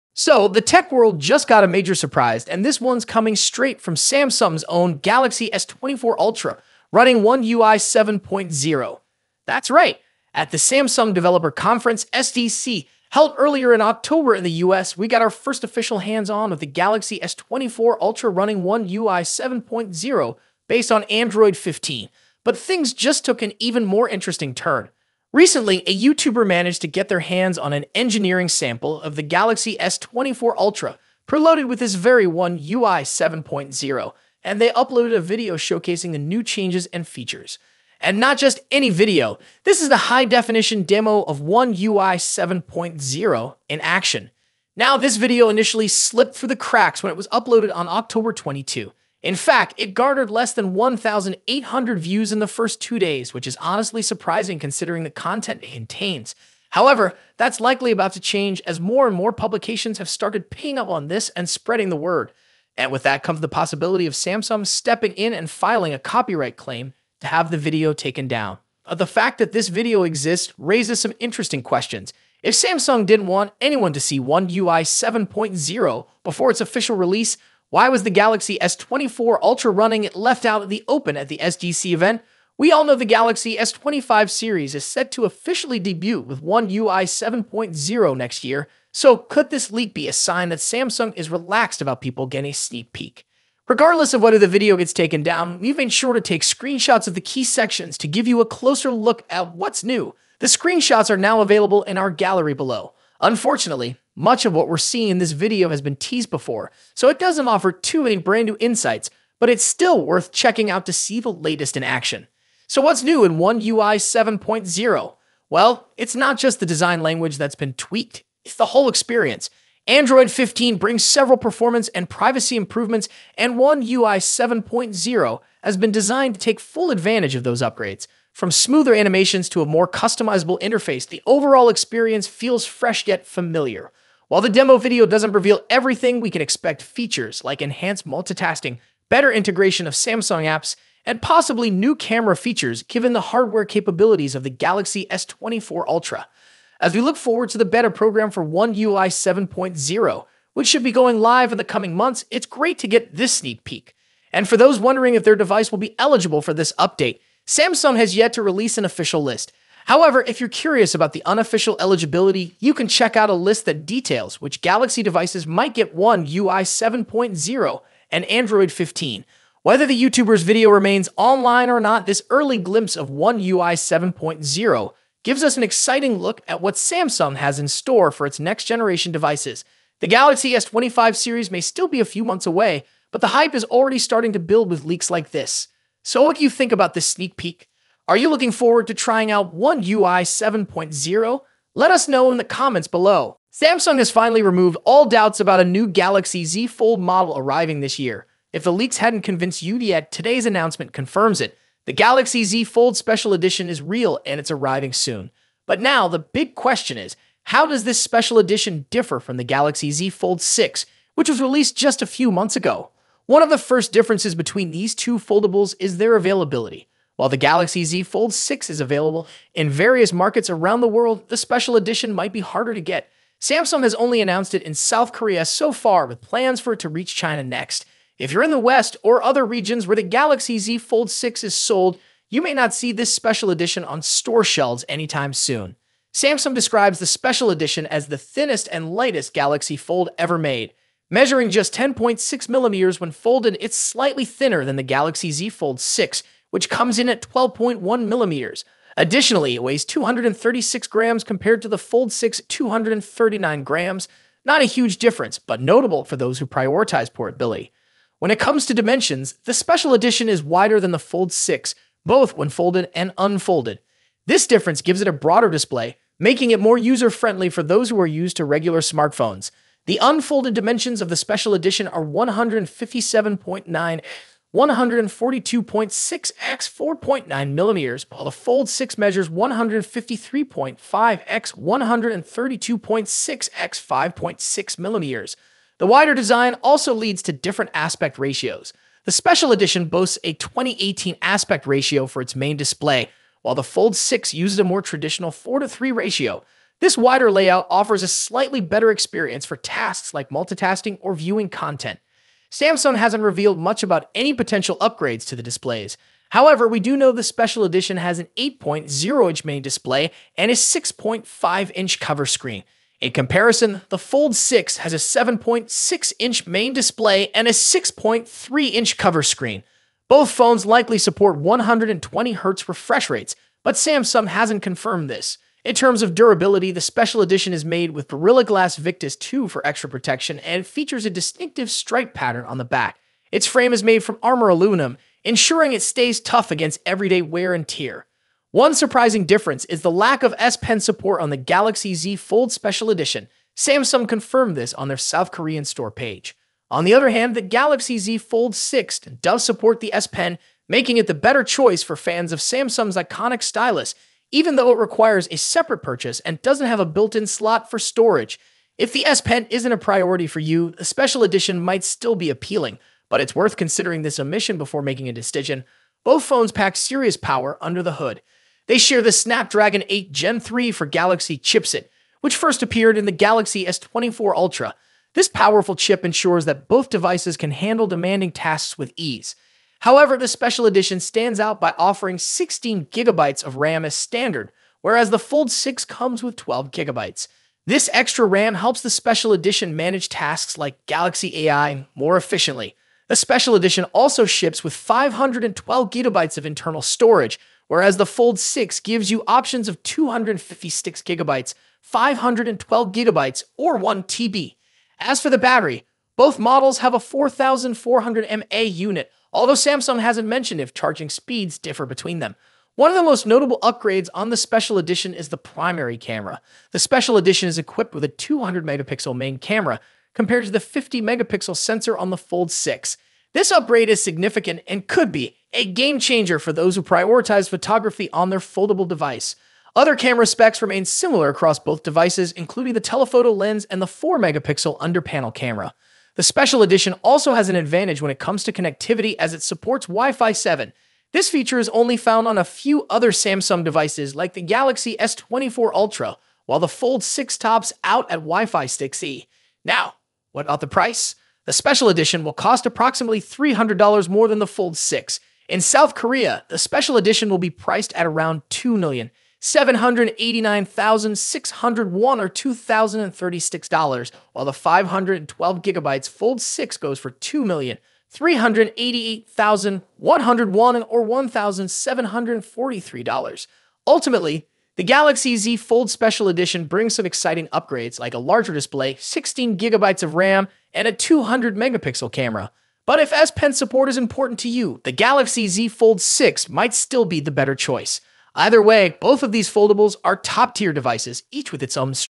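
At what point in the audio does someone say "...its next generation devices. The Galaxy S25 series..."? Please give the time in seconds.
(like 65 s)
178 s.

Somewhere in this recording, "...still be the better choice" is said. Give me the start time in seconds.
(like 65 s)
486 s.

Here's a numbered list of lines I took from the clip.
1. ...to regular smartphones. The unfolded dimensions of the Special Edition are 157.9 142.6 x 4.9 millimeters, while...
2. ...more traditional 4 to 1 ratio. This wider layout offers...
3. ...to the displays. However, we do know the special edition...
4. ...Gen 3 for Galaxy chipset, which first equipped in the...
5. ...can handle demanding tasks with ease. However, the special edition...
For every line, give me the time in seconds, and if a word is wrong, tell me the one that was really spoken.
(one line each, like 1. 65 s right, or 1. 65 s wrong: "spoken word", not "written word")
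1. 268 s right
2. 294 s wrong: "3", not "1"
3. 305 s right
4. 370 s wrong: "appeared", not "equipped"
5. 377 s right.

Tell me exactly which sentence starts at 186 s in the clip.
So, what do you think about this sneak peek?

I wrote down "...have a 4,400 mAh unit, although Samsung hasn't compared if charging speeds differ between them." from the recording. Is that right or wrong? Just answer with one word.
wrong.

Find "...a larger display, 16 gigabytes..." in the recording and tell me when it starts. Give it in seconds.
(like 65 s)
478 s.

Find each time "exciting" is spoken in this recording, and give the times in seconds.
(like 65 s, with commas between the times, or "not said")
175 s, 477 s.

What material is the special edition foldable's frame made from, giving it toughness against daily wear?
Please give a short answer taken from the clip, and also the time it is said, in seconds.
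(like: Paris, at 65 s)
Armor aluminum, at 334 s.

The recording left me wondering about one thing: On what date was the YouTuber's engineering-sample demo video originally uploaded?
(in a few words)
October 22.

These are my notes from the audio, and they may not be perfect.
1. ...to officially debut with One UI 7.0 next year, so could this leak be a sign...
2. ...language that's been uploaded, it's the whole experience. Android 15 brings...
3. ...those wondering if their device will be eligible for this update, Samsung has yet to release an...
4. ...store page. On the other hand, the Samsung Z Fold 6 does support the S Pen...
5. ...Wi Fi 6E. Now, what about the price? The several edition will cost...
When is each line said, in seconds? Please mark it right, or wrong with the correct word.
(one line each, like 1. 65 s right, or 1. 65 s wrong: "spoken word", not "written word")
1. 85 s right
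2. 117 s wrong: "tweaked", not "uploaded"
3. 154 s right
4. 345 s wrong: "Galaxy", not "Samsung"
5. 448 s wrong: "special", not "several".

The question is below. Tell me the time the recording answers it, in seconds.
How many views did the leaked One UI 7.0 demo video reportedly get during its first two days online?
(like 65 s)
50 s.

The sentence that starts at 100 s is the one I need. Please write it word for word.
The screenshots are now available in our gallery below.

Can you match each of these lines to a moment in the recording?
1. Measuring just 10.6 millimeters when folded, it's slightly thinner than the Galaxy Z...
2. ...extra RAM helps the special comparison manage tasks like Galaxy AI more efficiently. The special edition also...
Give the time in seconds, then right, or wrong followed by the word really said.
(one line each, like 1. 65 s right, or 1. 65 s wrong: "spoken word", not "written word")
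1. 241 s right
2. 387 s wrong: "edition", not "comparison".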